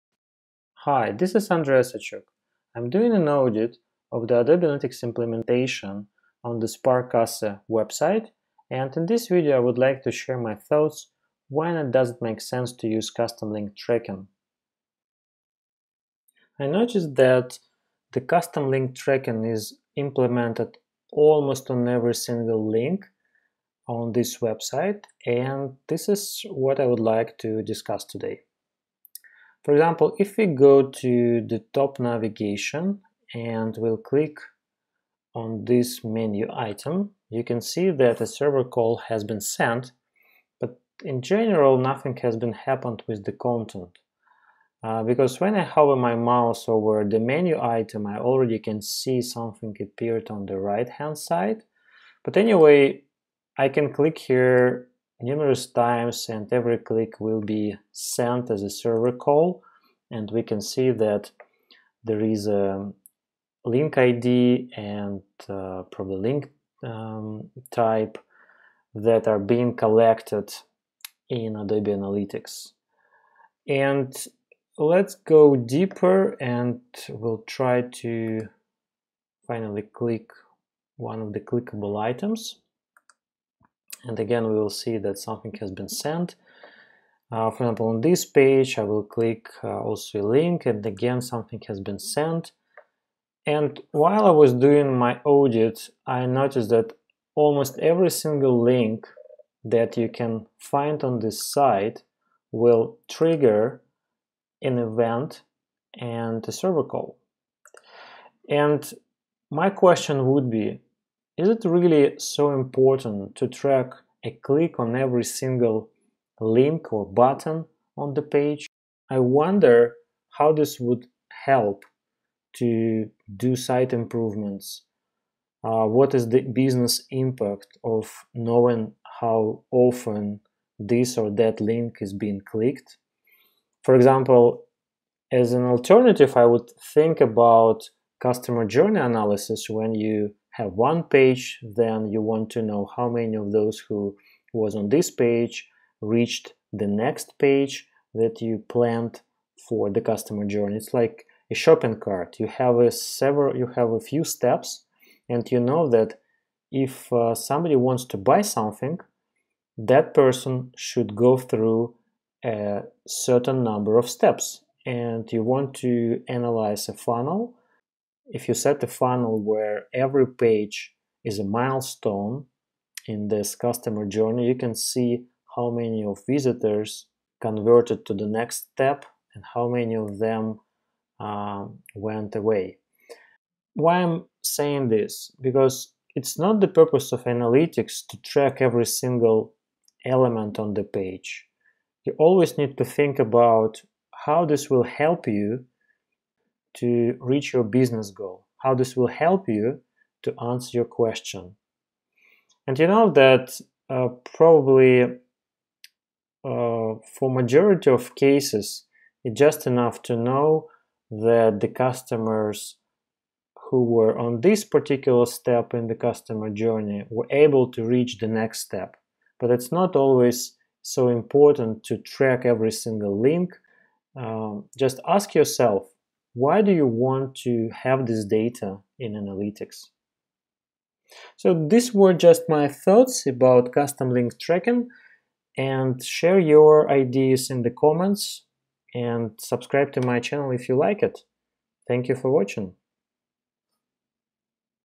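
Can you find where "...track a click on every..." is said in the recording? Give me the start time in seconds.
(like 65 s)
113 s.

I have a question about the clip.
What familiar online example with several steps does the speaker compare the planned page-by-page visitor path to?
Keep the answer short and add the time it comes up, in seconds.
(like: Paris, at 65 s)
a shopping cart, at 151 s.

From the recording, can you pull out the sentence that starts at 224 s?
Um, just ask yourself why do you want to have this data in analytics?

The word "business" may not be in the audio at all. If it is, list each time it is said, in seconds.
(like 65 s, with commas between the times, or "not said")
126 s, 197 s.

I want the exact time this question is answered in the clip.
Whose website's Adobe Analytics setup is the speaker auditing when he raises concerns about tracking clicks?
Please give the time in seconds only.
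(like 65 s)
6 s.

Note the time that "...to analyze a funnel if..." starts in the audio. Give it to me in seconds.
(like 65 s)
165 s.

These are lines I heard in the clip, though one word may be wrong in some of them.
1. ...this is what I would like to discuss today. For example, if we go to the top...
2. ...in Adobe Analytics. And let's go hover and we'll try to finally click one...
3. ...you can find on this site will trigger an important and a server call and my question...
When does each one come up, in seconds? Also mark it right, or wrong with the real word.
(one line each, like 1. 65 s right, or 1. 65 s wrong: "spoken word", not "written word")
1. 25 s right
2. 71 s wrong: "deeper", not "hover"
3. 99 s wrong: "event", not "important".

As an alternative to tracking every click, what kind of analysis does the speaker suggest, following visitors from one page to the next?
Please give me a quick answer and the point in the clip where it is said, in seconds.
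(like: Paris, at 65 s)
customer journey analysis, at 138 s.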